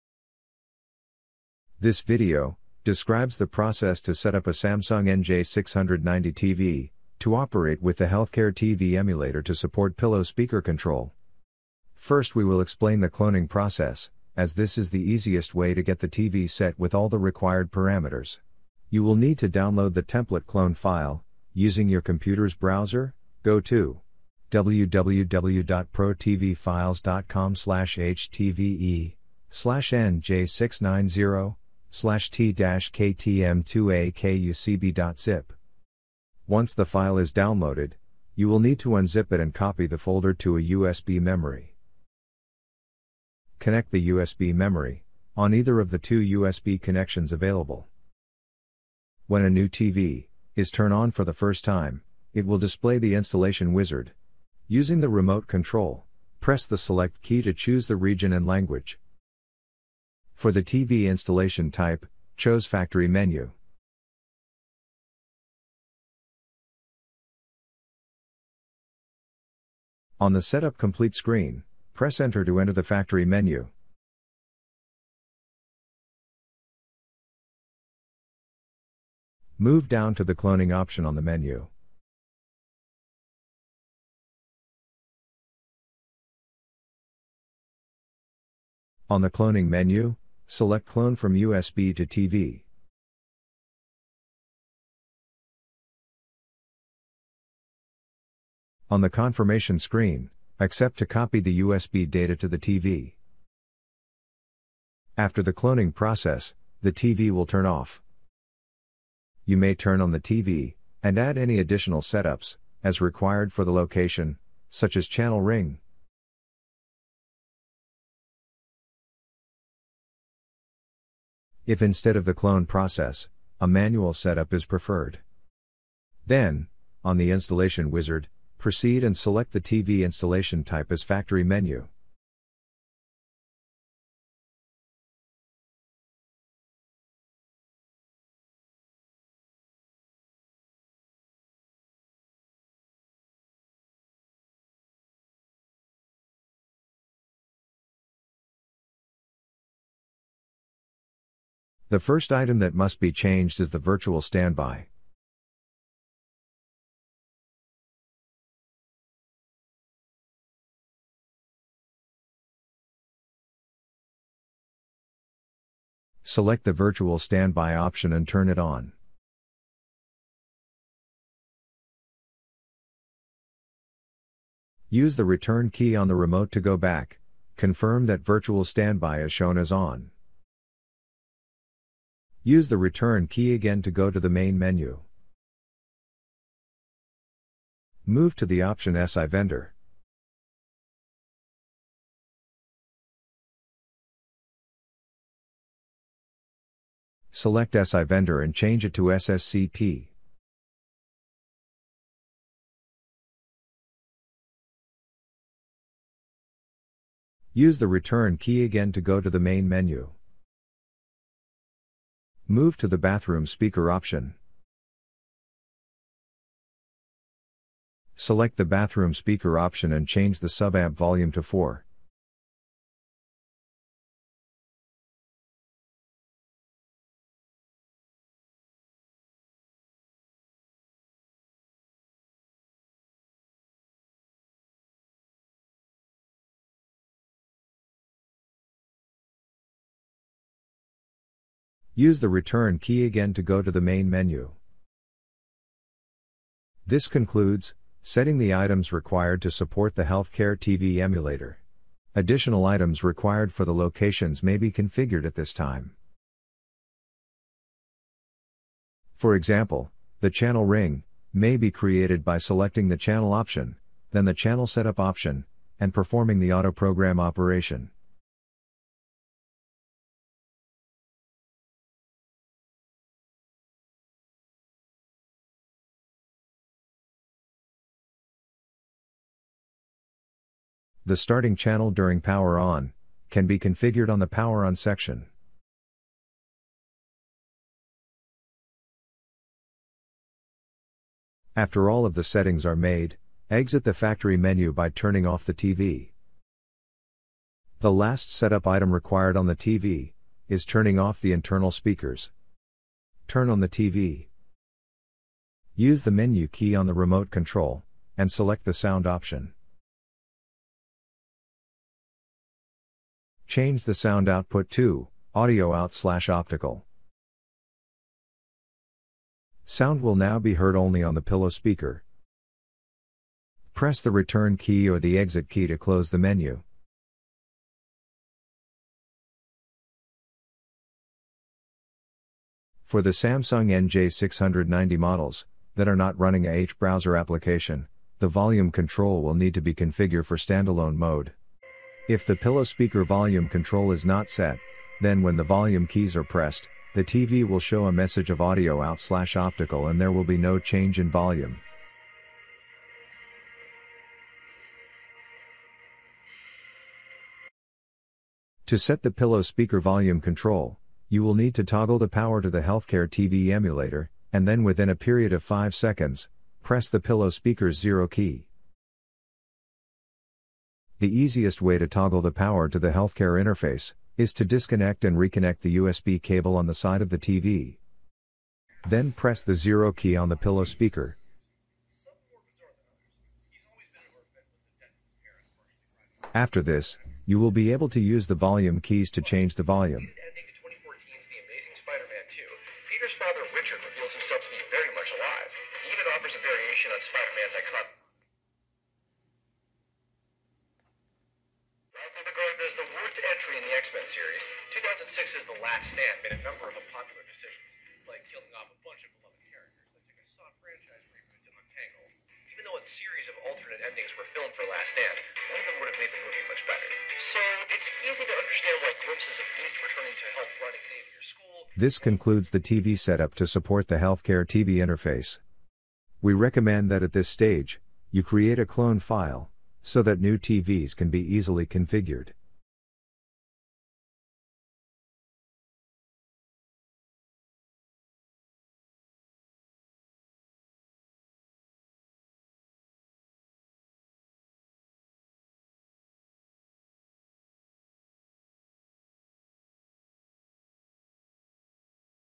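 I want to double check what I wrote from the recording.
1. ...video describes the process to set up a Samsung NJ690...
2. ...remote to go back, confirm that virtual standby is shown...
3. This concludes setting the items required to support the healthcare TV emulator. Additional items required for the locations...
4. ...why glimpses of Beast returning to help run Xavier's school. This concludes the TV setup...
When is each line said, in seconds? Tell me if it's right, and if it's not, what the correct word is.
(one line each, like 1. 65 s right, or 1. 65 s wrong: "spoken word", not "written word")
1. 2 s right
2. 176 s right
3. 246 s right
4. 418 s right.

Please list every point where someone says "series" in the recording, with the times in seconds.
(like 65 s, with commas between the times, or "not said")
404 s, 412 s.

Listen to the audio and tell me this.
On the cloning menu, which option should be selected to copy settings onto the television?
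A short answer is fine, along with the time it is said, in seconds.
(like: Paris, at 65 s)
Clone from USB to TV, at 90 s.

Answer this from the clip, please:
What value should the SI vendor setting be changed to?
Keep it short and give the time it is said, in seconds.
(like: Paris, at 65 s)
SSCP, at 199 s.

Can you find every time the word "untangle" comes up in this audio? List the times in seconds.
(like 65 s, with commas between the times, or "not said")
411 s.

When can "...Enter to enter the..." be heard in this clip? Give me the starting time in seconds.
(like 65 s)
72 s.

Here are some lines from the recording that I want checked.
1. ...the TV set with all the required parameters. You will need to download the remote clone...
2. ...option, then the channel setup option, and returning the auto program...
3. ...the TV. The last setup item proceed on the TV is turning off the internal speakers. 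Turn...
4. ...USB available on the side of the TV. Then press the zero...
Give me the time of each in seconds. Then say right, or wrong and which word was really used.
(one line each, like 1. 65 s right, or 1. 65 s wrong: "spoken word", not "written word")
1. 15 s wrong: "template", not "remote"
2. 263 s wrong: "performing", not "returning"
3. 295 s wrong: "required", not "proceed"
4. 375 s wrong: "cable", not "available".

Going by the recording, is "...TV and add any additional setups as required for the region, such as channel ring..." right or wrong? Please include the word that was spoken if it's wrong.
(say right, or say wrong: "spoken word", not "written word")
wrong: "location", not "region".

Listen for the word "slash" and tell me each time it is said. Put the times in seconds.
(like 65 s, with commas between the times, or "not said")
31 s, 315 s, 348 s.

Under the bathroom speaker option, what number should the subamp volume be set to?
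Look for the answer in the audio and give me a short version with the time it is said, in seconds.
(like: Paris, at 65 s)
4, at 221 s.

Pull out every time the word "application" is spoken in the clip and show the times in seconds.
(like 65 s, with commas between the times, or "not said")
337 s.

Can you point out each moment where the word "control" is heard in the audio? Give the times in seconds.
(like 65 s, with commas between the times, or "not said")
10 s, 55 s, 307 s, 338 s, 343 s, 360 s.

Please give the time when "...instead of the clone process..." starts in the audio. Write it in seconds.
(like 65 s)
121 s.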